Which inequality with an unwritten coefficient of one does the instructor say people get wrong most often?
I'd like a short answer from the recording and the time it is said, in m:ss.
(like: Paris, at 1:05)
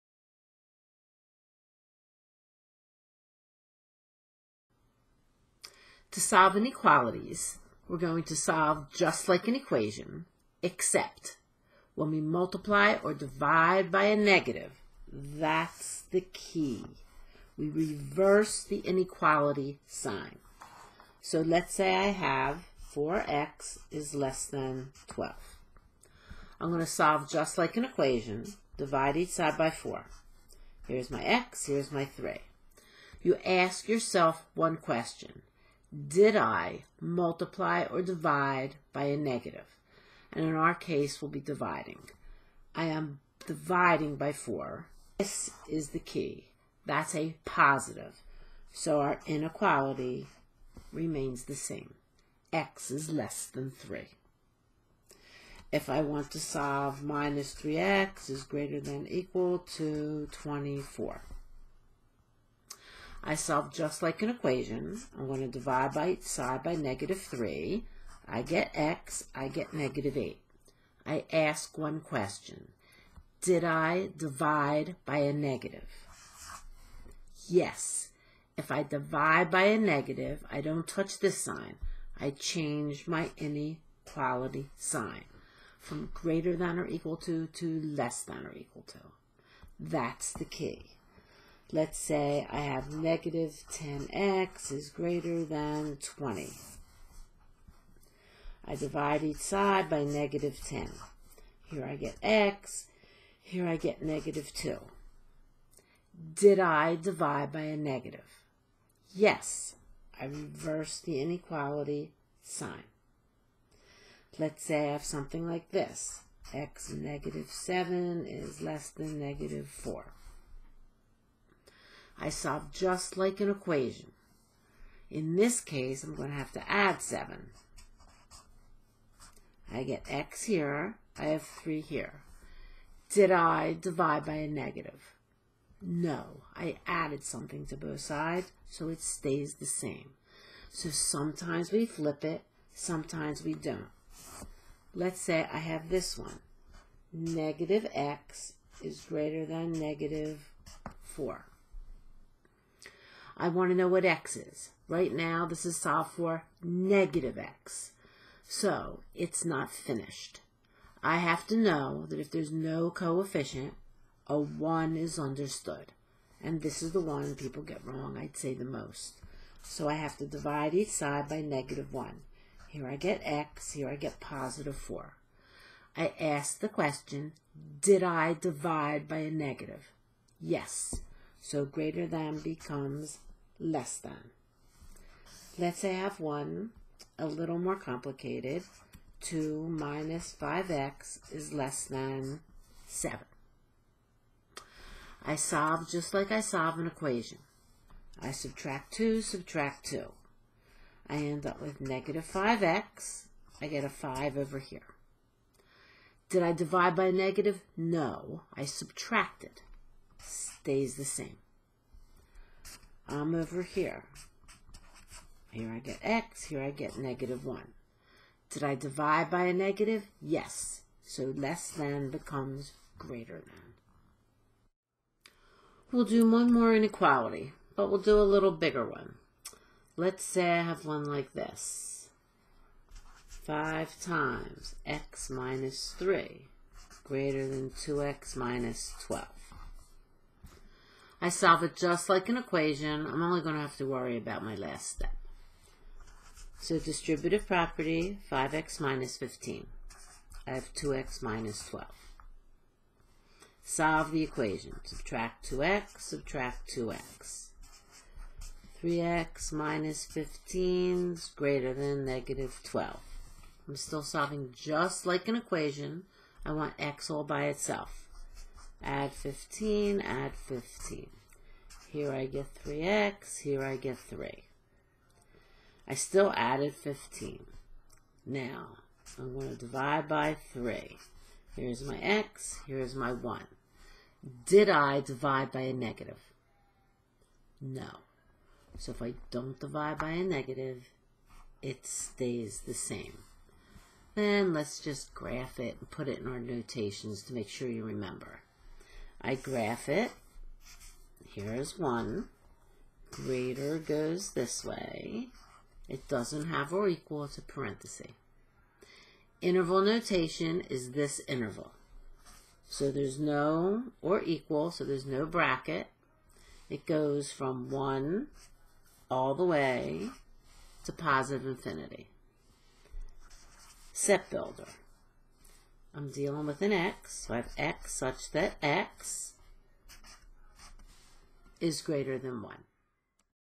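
Negative x is greater than negative 4, at 2:27.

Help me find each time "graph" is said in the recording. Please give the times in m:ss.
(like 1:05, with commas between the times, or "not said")
4:55, 4:59.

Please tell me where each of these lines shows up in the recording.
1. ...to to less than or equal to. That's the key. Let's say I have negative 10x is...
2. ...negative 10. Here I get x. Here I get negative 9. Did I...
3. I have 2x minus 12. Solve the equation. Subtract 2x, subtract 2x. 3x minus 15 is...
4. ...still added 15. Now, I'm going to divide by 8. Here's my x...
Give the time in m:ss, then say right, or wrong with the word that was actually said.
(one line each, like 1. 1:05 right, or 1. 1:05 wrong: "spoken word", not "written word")
1. 1:27 right
2. 1:40 wrong: "2", not "9"
3. 4:10 right
4. 4:35 wrong: "3", not "8".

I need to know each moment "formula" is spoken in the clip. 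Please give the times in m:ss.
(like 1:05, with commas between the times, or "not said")
not said.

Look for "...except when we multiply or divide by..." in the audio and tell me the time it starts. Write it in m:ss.
0:10.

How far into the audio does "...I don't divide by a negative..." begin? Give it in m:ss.
4:49.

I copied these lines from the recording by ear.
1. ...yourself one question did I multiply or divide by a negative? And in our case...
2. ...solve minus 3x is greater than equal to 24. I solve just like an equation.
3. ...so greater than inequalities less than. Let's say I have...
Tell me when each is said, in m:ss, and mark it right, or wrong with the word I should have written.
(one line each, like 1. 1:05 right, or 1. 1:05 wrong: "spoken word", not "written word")
1. 0:33 right
2. 0:56 right
3. 3:01 wrong: "becomes", not "inequalities".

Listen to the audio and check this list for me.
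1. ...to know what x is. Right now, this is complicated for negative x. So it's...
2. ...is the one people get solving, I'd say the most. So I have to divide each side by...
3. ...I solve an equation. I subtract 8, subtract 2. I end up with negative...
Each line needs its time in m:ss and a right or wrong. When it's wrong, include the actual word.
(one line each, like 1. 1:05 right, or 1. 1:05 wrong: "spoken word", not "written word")
1. 2:33 wrong: "solved", not "complicated"
2. 2:46 wrong: "wrong", not "solving"
3. 3:16 wrong: "2", not "8".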